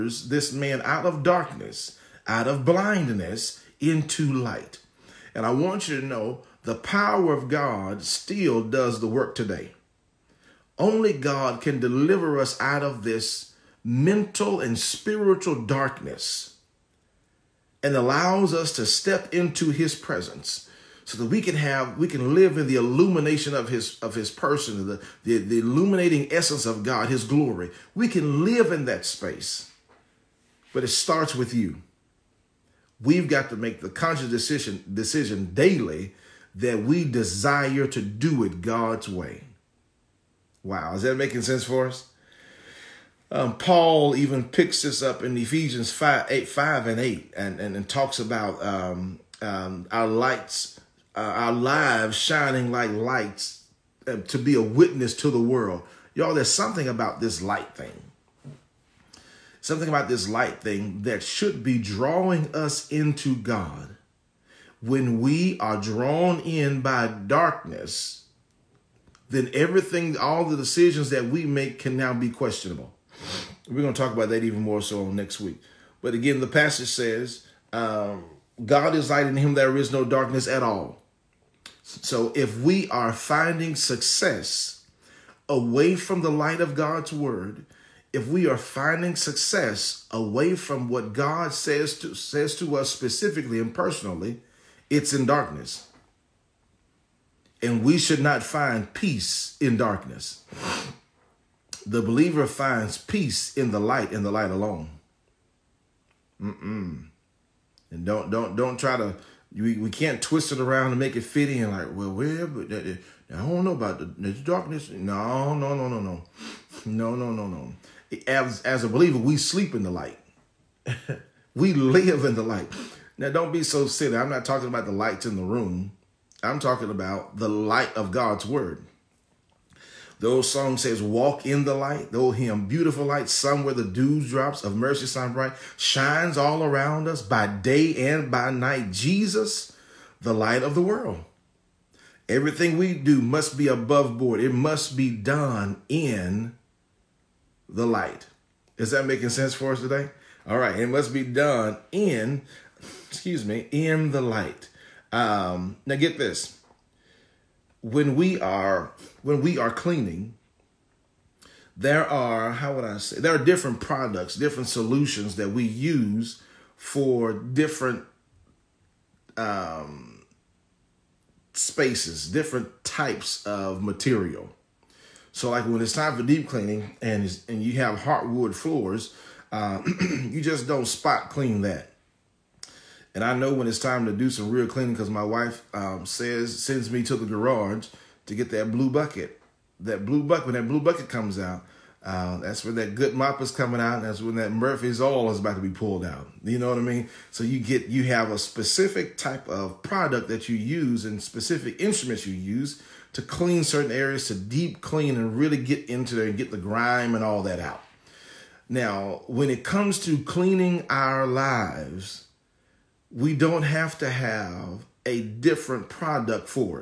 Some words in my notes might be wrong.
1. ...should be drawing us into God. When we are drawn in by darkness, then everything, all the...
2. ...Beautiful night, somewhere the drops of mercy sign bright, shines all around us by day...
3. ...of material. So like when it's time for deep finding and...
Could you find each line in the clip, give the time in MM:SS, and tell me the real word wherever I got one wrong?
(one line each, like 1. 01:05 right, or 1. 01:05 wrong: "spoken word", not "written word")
1. 01:01 right
2. 02:12 wrong: "light", not "night"
3. 02:53 wrong: "cleaning", not "finding".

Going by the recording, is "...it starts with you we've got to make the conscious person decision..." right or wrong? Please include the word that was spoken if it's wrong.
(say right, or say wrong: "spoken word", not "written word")
wrong: "decision", not "person".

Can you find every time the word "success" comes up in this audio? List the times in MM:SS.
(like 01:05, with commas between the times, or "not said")
01:23, 01:29.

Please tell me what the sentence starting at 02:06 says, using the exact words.
I'm talking about the light of God's word.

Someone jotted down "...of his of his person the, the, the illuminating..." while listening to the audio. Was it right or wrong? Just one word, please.
right.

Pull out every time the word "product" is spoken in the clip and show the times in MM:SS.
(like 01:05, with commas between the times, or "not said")
02:43, 03:19, 03:35.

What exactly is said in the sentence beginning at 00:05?
And I want you to know the power of God still does the work today.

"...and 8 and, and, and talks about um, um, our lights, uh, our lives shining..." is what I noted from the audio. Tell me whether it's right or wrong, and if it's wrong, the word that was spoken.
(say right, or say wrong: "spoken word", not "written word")
right.